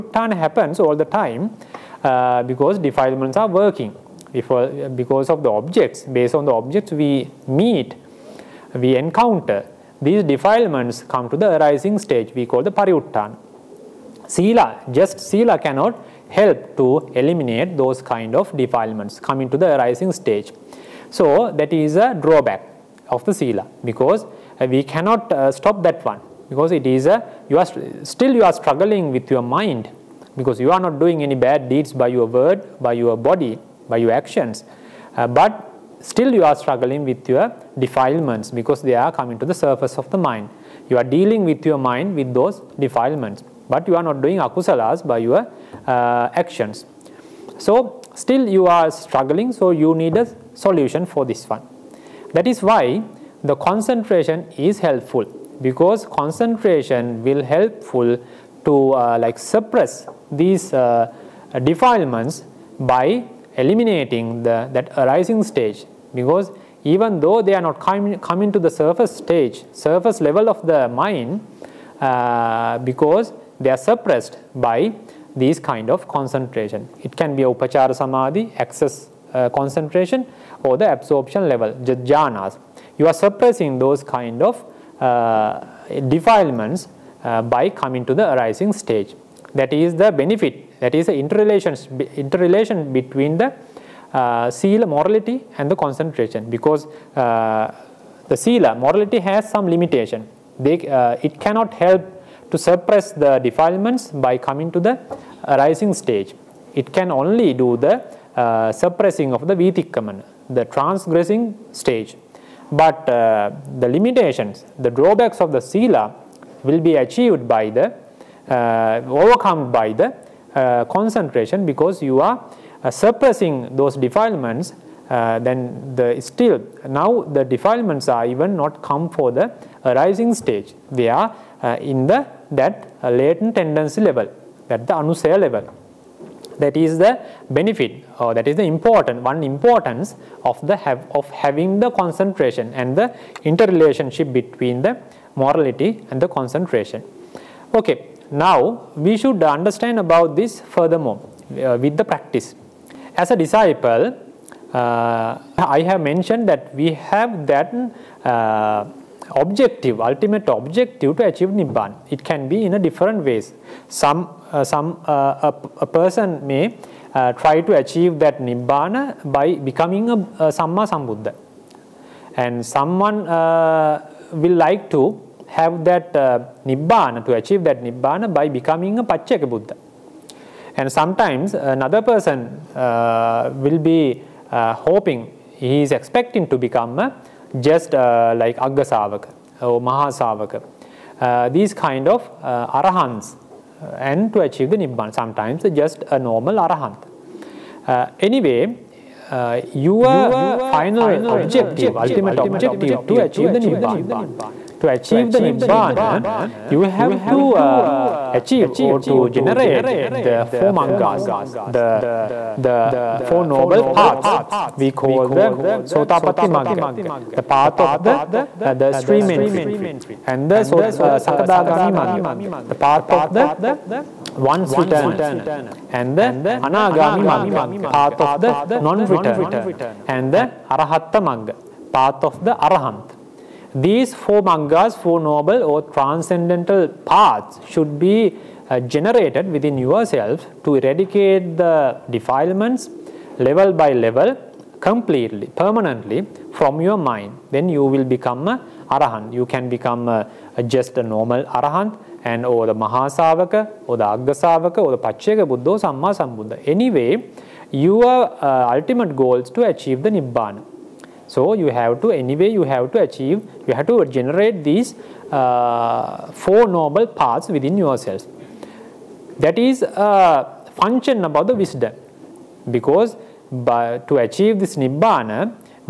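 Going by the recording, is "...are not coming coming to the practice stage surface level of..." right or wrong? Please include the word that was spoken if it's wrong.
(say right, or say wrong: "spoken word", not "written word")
wrong: "surface", not "practice".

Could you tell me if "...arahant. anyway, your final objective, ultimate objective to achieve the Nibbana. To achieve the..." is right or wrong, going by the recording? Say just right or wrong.
right.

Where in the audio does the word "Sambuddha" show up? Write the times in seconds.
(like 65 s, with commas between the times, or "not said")
170 s, 256 s.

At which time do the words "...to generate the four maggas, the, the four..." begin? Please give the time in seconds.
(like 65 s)
209 s.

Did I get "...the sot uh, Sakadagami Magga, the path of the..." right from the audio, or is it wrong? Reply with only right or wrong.
right.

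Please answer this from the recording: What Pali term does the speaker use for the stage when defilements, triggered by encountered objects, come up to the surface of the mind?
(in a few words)
pariyuttana.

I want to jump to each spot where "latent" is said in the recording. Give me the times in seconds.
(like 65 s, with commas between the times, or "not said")
133 s.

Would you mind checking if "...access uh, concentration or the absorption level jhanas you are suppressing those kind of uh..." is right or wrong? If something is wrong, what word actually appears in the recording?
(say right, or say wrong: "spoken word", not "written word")
right.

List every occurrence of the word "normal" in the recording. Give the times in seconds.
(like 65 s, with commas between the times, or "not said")
196 s, 251 s.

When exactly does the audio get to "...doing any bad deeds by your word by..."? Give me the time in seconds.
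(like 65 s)
30 s.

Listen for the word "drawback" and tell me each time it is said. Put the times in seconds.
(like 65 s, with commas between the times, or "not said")
22 s, 114 s.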